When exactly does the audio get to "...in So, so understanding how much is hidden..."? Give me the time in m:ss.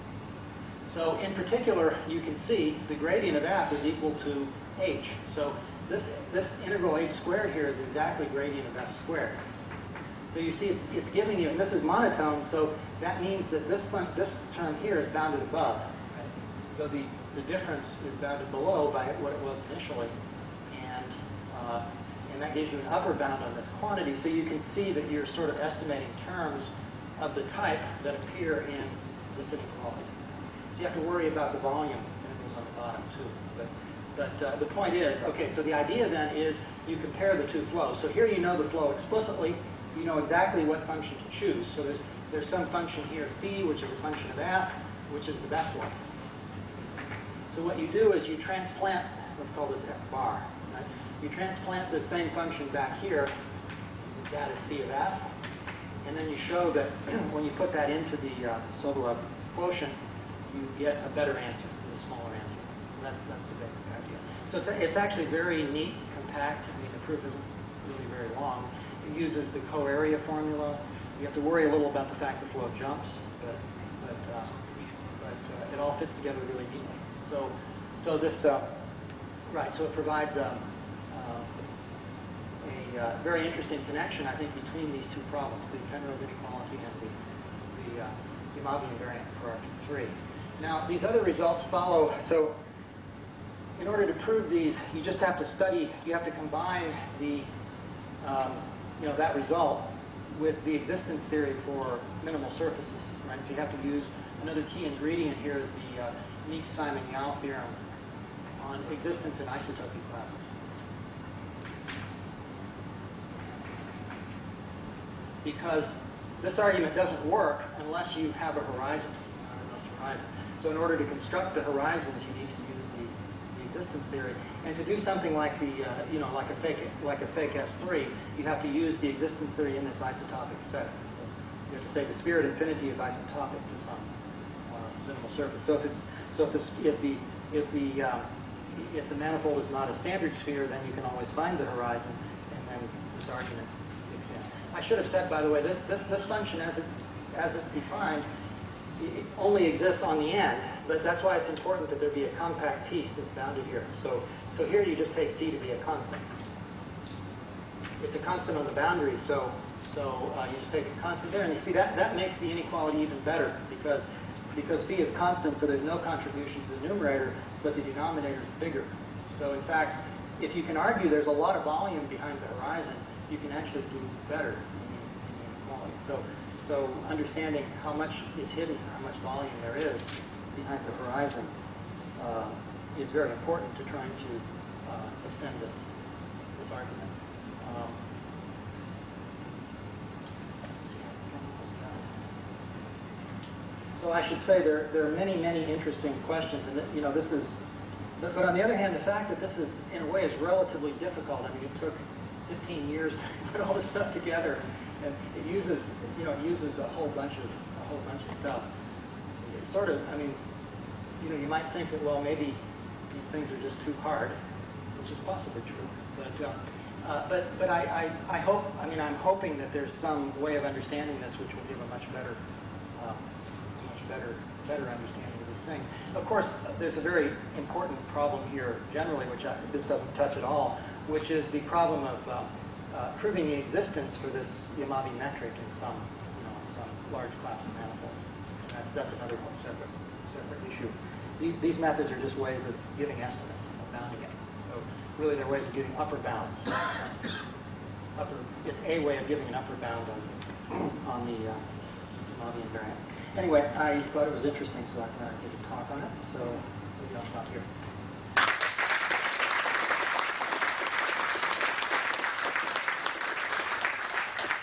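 2:55.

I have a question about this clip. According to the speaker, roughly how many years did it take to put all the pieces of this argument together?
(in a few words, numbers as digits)
15.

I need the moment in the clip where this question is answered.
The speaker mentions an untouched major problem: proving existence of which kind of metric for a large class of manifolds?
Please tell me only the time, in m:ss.
3:54.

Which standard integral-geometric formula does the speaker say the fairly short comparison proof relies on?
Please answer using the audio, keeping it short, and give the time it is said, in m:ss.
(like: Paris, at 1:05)
coarea formula, at 1:09.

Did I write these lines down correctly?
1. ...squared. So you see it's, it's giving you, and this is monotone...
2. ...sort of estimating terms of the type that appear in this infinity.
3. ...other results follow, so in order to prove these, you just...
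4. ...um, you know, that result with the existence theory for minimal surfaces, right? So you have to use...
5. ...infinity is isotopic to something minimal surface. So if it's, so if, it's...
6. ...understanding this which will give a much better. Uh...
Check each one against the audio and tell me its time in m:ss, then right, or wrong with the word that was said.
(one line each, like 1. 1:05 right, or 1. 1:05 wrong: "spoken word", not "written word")
1. 0:09 right
2. 0:25 wrong: "inequality", not "infinity"
3. 1:31 right
4. 1:38 right
5. 2:12 right
6. 3:40 right.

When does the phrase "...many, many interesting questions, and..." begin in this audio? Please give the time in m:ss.
3:15.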